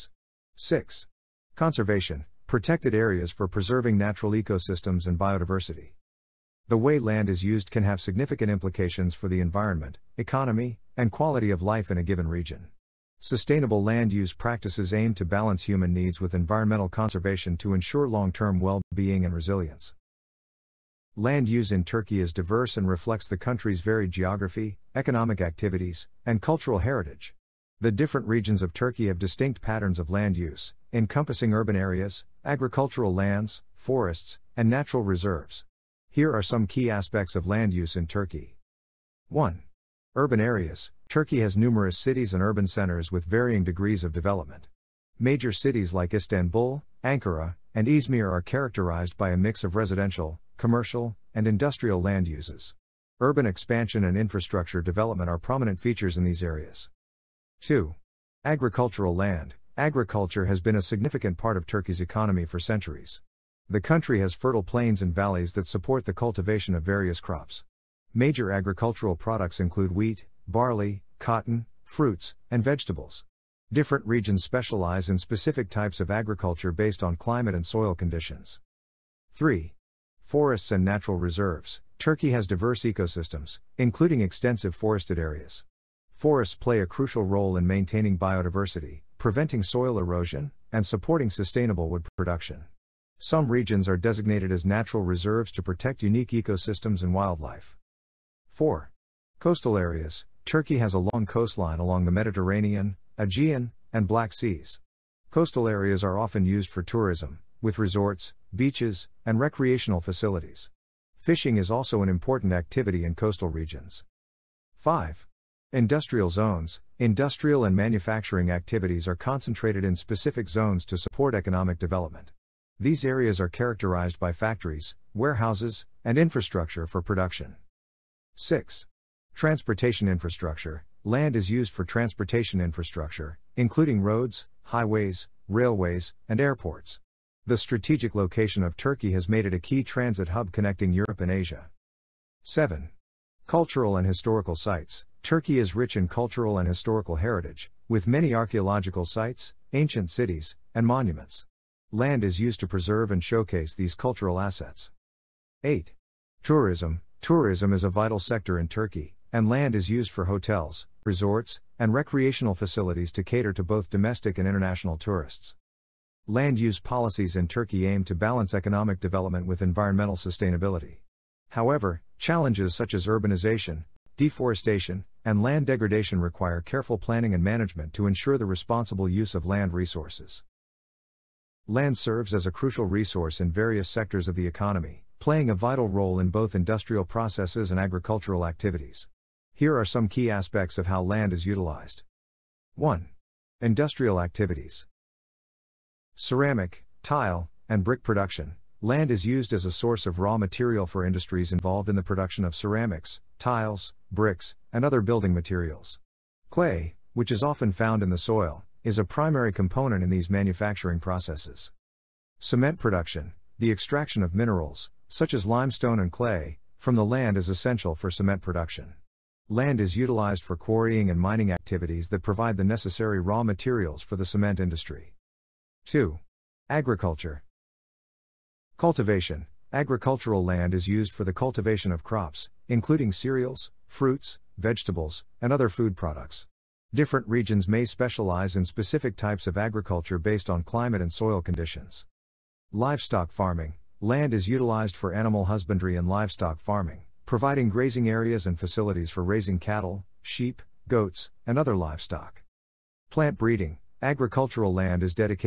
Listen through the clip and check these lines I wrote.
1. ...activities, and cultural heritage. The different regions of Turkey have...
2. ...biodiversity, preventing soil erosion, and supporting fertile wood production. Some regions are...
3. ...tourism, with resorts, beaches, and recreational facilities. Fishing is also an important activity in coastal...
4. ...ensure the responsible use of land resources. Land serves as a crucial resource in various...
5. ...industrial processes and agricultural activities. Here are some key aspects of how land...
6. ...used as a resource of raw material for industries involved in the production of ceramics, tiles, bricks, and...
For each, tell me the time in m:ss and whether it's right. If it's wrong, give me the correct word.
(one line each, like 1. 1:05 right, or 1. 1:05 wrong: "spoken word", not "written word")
1. 0:25 right
2. 1:28 wrong: "sustainable", not "fertile"
3. 1:46 right
4. 2:58 right
5. 3:06 right
6. 3:19 wrong: "source", not "resource".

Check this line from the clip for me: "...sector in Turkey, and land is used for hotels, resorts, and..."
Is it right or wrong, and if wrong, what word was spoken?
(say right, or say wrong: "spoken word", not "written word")
right.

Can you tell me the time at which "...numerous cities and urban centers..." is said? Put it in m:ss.
0:41.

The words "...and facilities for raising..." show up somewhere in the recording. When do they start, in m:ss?
4:08.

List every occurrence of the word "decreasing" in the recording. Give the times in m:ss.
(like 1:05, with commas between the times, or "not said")
not said.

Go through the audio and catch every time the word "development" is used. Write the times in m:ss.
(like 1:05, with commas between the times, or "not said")
0:44, 0:54, 2:01, 2:48.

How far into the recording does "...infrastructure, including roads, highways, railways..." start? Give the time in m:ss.
2:12.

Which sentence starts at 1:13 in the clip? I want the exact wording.
Different regions specialize in specific types of agriculture based on climate and soil conditions.